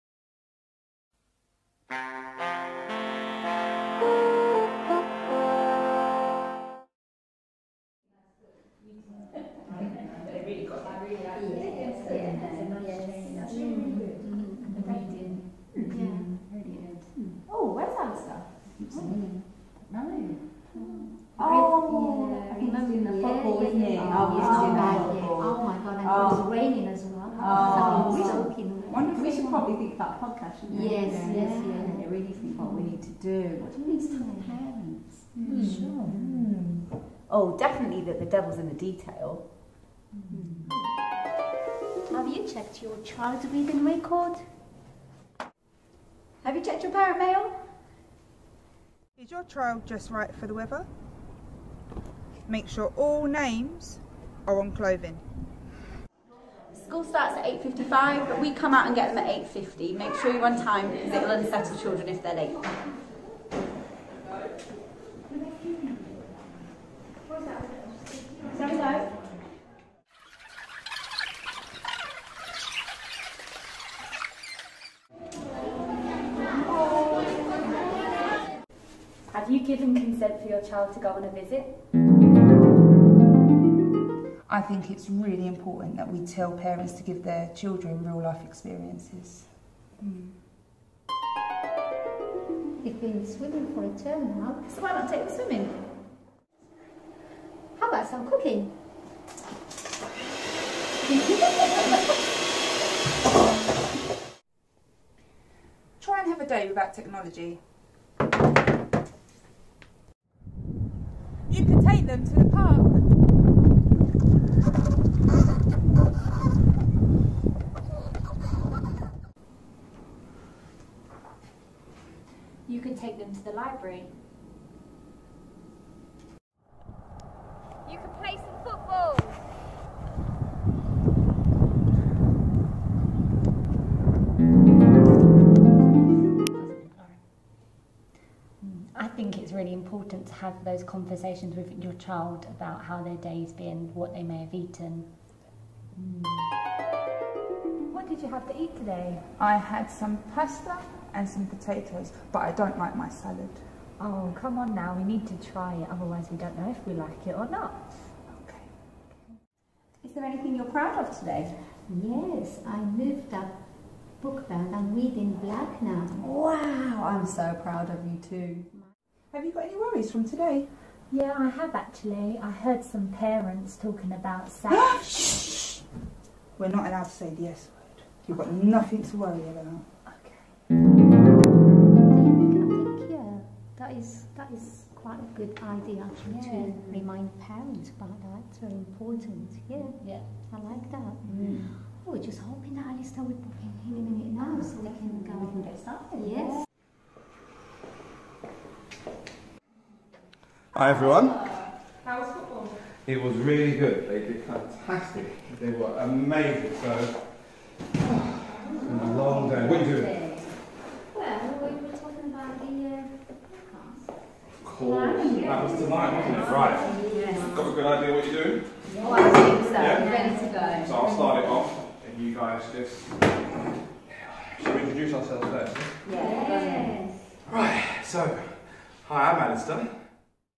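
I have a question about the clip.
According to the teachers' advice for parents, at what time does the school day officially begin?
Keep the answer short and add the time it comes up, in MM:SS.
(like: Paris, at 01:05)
8.55, at 00:57.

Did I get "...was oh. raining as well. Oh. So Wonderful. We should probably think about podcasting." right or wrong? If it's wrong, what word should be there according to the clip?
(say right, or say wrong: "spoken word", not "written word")
right.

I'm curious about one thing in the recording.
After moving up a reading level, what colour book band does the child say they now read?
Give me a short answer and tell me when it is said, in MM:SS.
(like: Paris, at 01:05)
black, at 02:45.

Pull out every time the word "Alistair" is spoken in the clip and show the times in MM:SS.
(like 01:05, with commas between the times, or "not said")
03:12, 03:49.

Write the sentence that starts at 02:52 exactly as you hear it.
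I heard some parents talking about sex.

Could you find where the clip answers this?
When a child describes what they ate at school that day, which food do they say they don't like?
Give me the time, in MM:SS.
02:33.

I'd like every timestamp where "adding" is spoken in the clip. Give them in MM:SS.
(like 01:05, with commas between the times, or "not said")
not said.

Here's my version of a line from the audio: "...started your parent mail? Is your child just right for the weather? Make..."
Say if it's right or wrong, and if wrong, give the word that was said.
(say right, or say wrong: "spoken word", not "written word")
wrong: "checked", not "started".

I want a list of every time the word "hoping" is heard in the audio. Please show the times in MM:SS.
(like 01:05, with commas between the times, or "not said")
03:12.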